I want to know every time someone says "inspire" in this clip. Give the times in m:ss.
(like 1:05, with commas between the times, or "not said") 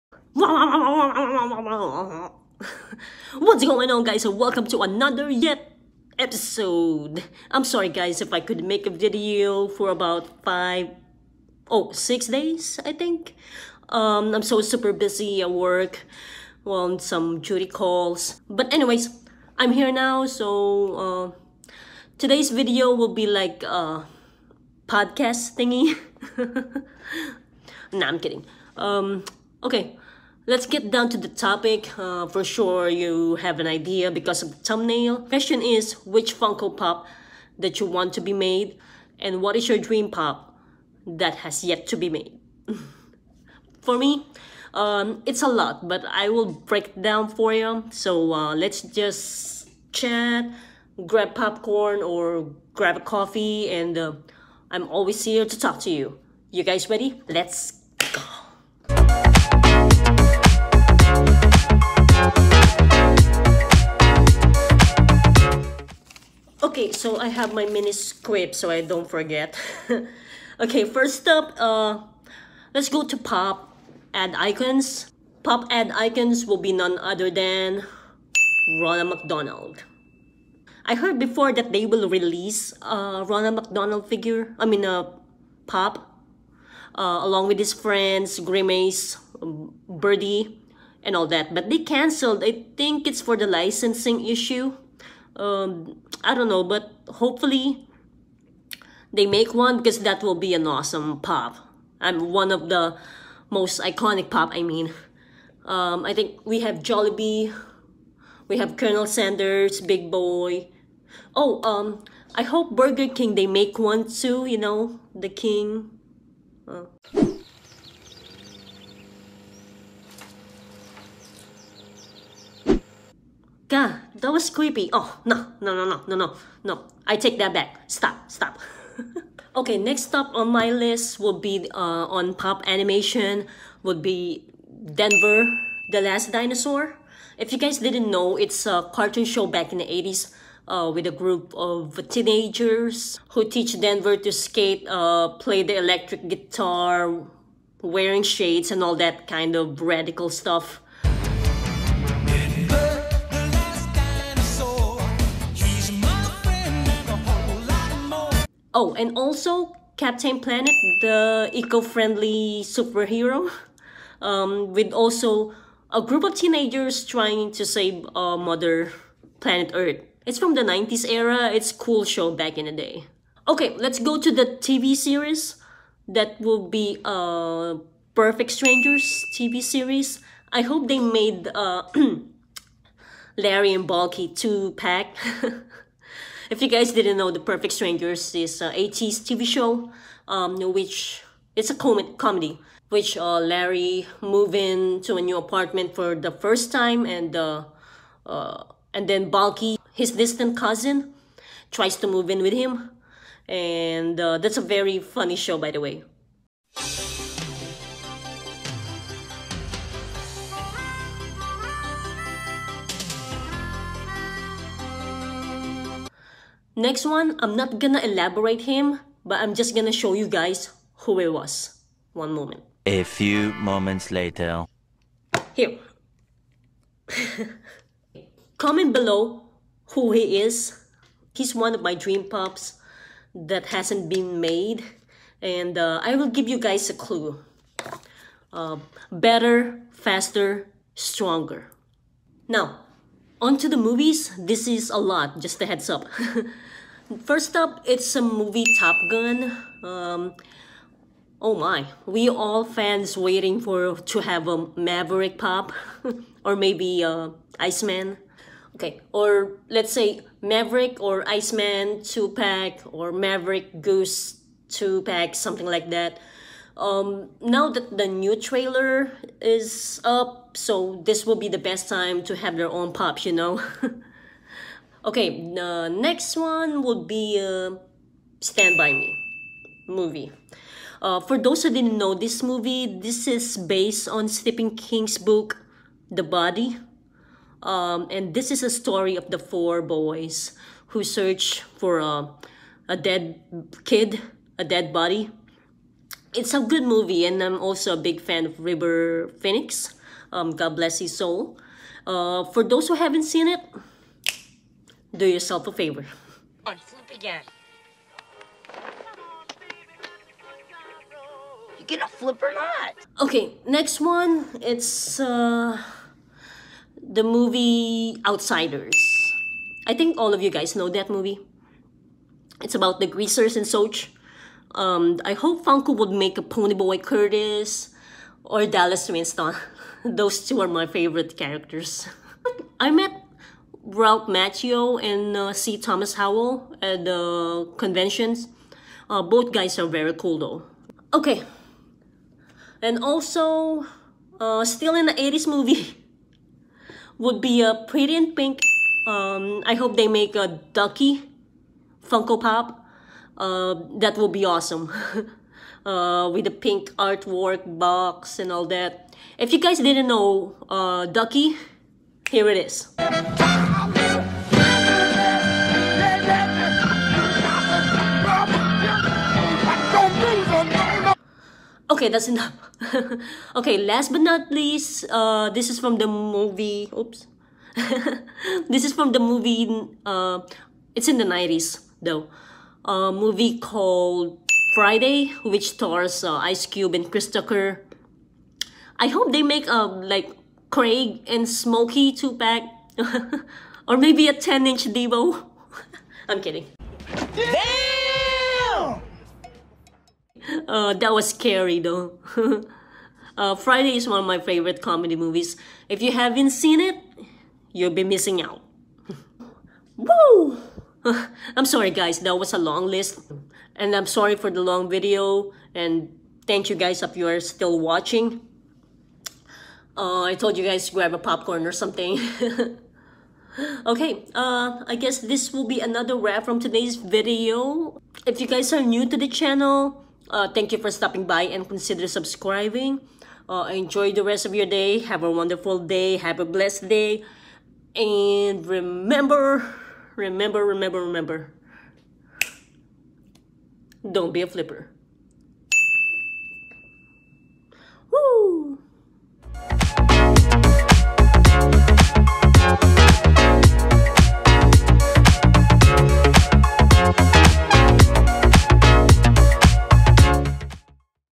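not said.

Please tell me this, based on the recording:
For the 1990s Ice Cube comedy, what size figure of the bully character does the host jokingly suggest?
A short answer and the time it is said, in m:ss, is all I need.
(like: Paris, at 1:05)
10 inch, at 6:34.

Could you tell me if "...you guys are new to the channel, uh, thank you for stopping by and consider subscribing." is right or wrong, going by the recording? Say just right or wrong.
right.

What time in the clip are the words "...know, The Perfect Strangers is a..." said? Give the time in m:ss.
3:07.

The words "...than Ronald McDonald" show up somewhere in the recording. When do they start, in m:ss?
1:17.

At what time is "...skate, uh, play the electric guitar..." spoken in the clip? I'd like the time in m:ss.
2:24.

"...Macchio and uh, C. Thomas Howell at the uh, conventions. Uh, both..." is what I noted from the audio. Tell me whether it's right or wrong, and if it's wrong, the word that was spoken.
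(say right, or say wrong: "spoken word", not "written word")
right.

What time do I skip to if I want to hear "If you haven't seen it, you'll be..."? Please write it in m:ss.
6:45.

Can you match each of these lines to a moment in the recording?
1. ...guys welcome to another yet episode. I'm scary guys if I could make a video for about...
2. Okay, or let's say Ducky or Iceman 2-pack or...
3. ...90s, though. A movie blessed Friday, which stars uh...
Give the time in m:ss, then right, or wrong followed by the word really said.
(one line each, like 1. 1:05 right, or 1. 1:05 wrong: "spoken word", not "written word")
1. 0:04 wrong: "sorry", not "scary"
2. 4:18 wrong: "Maverick", not "Ducky"
3. 6:21 wrong: "called", not "blessed".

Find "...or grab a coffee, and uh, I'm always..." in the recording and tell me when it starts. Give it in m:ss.
0:52.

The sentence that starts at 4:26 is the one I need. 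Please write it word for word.
Um, now that the new trailer is up, so this will be the best time to have their own pups, you know.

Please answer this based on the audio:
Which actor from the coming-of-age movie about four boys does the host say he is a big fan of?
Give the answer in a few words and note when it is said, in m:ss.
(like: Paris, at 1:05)
River Phoenix, at 4:58.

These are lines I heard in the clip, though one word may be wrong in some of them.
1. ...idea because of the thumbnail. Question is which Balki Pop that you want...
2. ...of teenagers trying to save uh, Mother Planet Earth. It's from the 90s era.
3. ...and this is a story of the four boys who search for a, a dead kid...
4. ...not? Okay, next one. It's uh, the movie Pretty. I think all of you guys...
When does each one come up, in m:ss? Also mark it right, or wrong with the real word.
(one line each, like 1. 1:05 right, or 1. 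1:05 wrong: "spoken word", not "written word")
1. 0:33 wrong: "Funko", not "Balki"
2. 2:46 right
3. 4:48 right
4. 5:12 wrong: "Outsiders", not "Pretty".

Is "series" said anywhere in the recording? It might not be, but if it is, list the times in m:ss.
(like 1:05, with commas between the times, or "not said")
2:54, 2:59.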